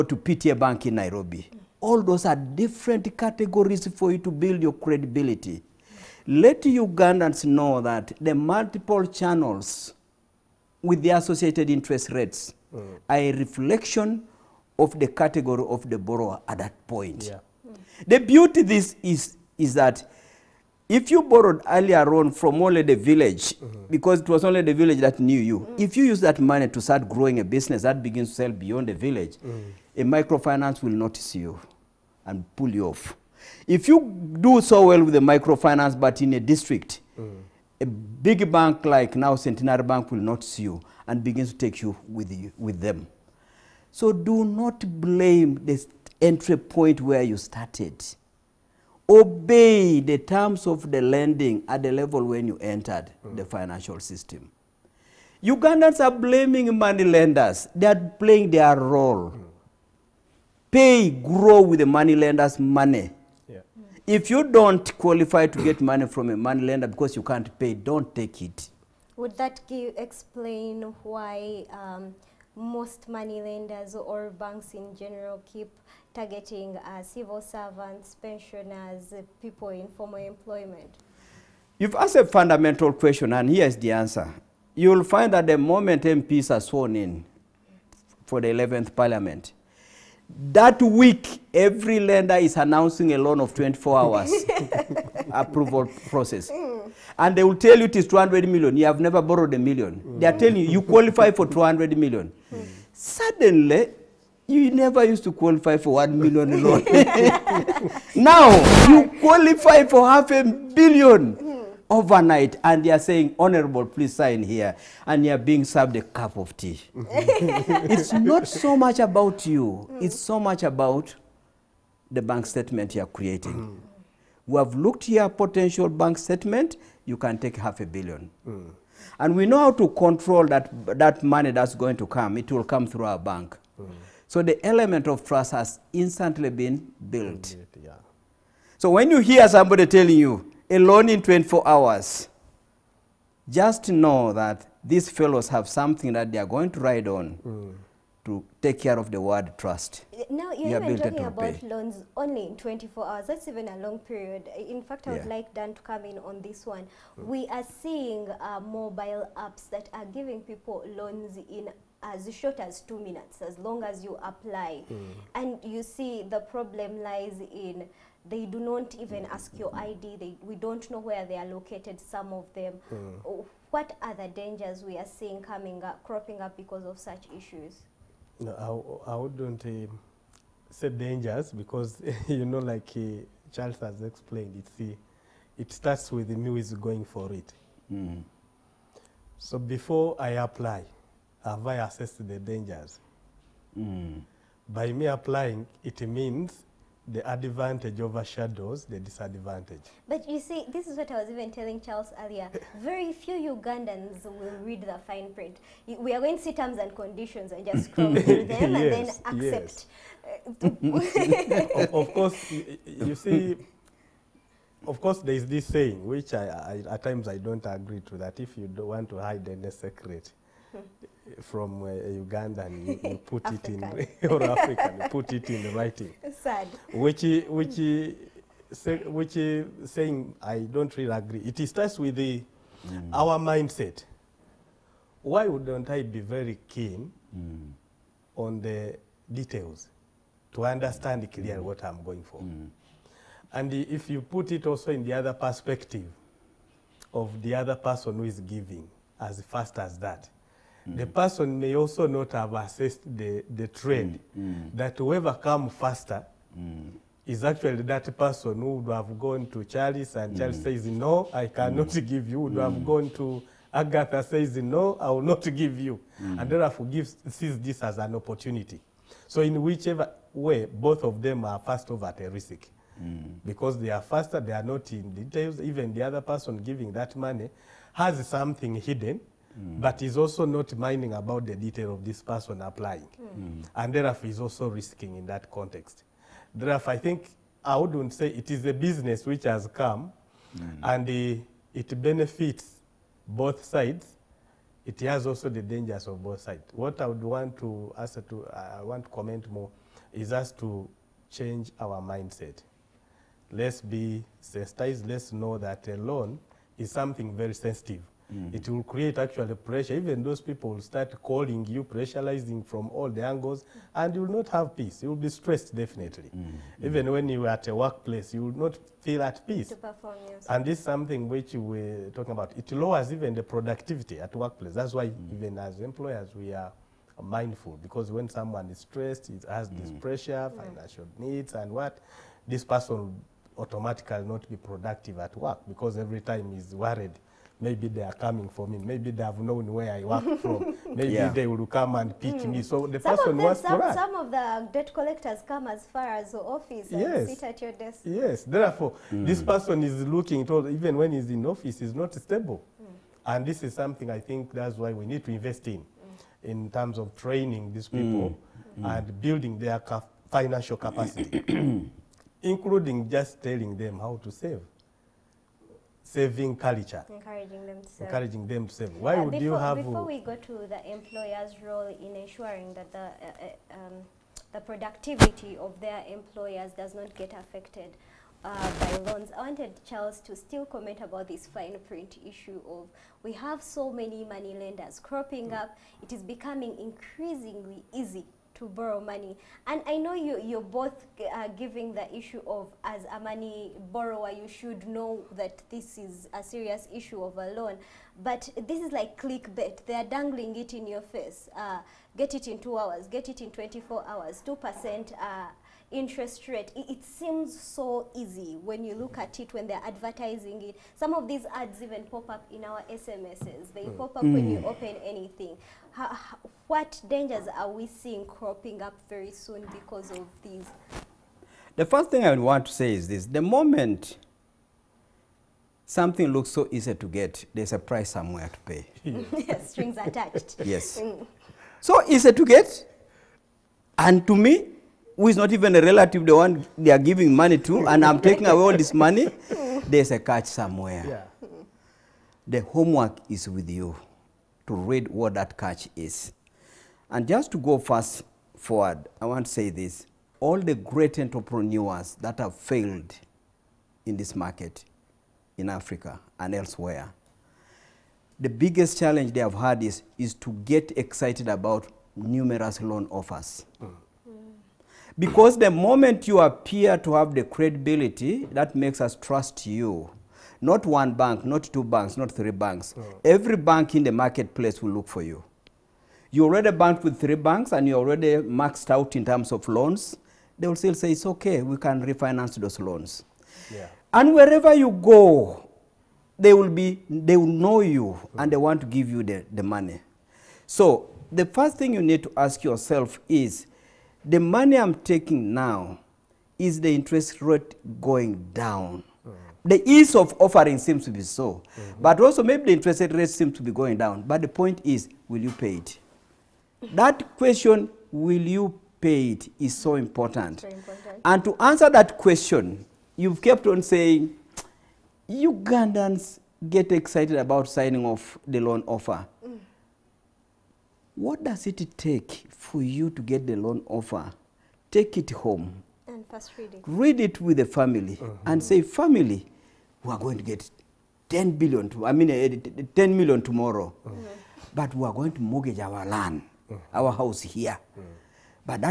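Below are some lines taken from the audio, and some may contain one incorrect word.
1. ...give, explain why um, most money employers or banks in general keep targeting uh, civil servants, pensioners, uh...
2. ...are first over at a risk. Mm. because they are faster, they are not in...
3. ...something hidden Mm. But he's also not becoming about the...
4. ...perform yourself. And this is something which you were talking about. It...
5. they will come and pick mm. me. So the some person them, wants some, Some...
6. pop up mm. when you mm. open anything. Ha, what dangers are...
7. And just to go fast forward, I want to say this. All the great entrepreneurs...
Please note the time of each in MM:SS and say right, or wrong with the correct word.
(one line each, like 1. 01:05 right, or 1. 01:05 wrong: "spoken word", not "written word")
1. 01:09 wrong: "lenders", not "employers"
2. 04:31 right
3. 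04:38 wrong: "minding", not "becoming"
4. 05:19 right
5. 05:41 right
6. 06:53 right
7. 07:27 right.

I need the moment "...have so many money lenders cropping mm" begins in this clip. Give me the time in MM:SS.
06:23.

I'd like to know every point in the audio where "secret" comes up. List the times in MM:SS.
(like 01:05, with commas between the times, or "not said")
03:39.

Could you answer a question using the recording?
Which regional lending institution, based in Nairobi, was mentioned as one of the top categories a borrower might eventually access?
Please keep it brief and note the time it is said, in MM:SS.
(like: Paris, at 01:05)
PTA Bank, at 00:00.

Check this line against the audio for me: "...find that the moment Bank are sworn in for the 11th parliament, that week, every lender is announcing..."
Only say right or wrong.
wrong.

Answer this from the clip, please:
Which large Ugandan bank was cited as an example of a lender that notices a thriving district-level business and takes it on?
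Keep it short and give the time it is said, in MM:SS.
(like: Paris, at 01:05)
Centenary Bank, at 00:39.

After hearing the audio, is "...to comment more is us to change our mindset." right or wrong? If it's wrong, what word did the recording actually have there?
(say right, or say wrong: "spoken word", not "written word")
right.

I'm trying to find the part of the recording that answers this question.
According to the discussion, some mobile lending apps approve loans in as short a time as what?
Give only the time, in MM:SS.
02:42.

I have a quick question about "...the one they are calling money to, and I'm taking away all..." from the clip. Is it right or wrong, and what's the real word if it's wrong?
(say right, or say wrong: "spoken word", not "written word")
wrong: "giving", not "calling".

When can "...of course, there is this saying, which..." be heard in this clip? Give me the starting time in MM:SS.
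03:34.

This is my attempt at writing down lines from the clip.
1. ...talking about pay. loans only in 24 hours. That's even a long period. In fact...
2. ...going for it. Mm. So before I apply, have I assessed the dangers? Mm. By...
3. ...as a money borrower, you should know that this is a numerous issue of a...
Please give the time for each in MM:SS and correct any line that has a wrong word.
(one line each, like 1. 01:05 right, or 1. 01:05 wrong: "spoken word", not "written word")
1. 02:30 right
2. 03:06 right
3. 06:32 wrong: "serious", not "numerous".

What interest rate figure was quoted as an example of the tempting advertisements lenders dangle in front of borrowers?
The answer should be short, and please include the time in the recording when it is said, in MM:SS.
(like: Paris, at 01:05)
2%, at 06:44.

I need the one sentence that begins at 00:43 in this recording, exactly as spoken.
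So do not blame the entry point where you started.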